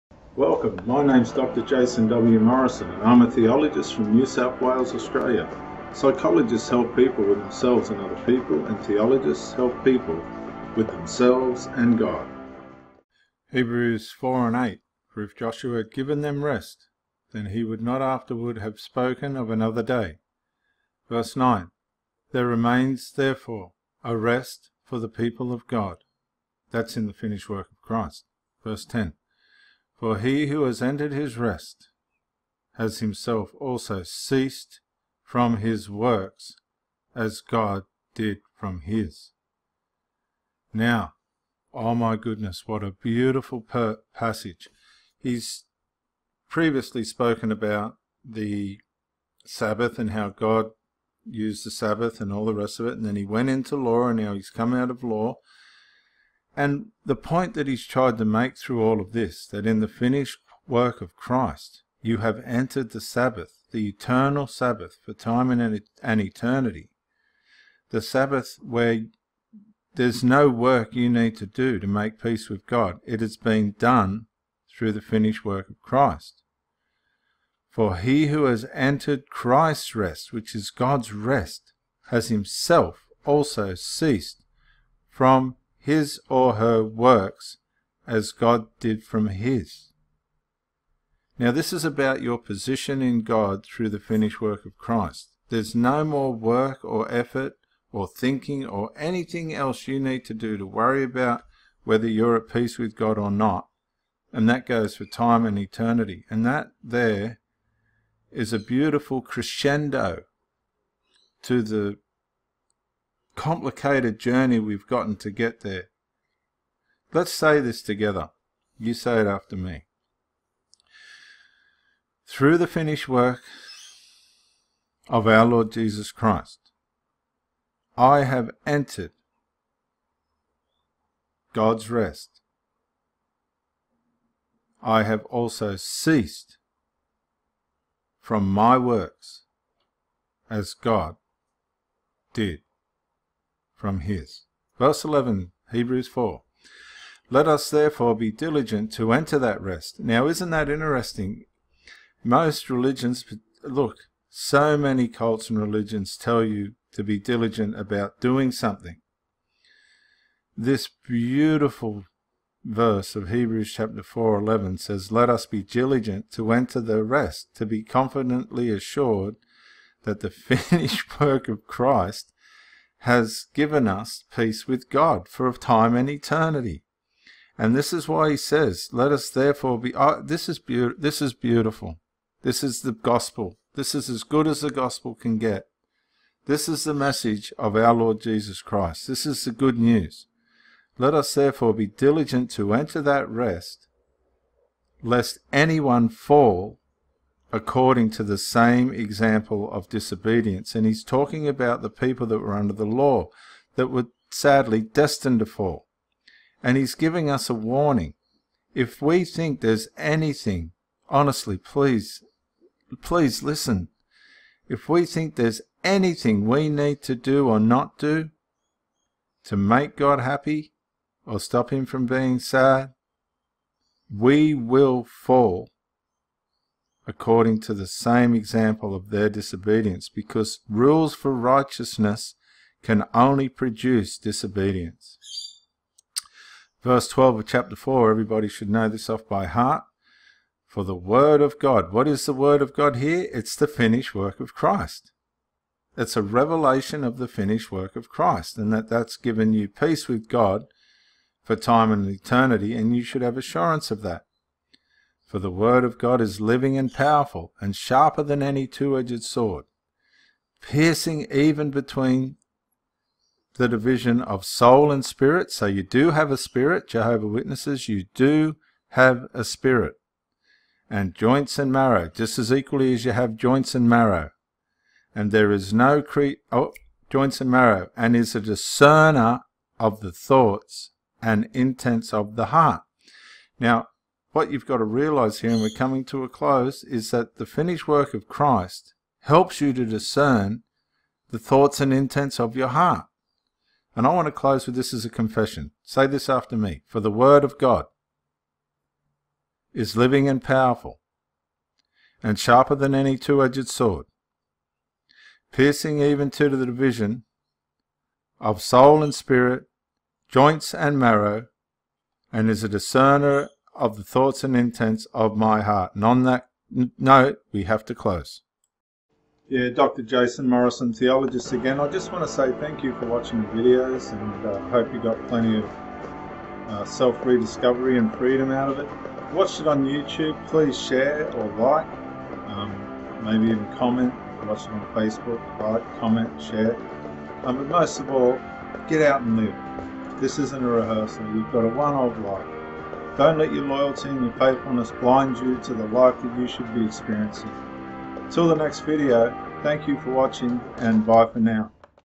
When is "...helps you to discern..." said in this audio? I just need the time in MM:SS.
04:49.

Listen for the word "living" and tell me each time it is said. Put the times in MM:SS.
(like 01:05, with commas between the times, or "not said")
04:16, 04:59.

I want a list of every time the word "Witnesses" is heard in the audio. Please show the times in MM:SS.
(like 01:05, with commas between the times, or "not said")
04:27.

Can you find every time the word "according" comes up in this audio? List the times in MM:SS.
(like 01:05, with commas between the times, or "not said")
03:17, 03:47.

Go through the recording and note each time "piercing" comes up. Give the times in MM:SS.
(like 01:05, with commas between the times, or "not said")
04:20, 05:05.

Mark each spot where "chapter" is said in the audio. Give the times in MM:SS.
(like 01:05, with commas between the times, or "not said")
02:43, 03:57.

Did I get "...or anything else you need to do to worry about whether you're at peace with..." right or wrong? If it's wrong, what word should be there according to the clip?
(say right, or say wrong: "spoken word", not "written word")
right.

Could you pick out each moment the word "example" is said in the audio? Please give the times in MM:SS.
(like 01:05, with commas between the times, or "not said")
03:18, 03:48.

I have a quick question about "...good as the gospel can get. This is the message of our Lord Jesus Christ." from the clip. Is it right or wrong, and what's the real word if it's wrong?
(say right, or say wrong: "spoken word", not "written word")
right.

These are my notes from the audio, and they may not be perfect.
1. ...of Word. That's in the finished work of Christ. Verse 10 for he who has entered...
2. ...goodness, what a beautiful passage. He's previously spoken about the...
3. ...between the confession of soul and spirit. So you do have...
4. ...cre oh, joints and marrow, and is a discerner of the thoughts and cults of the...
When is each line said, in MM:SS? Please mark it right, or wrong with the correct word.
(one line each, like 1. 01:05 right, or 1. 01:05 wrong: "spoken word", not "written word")
1. 00:25 wrong: "God", not "Word"
2. 00:42 right
3. 04:21 wrong: "division", not "confession"
4. 04:36 wrong: "intents", not "cults".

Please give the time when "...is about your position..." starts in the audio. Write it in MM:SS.
01:31.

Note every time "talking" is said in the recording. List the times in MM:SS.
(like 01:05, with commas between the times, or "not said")
03:21.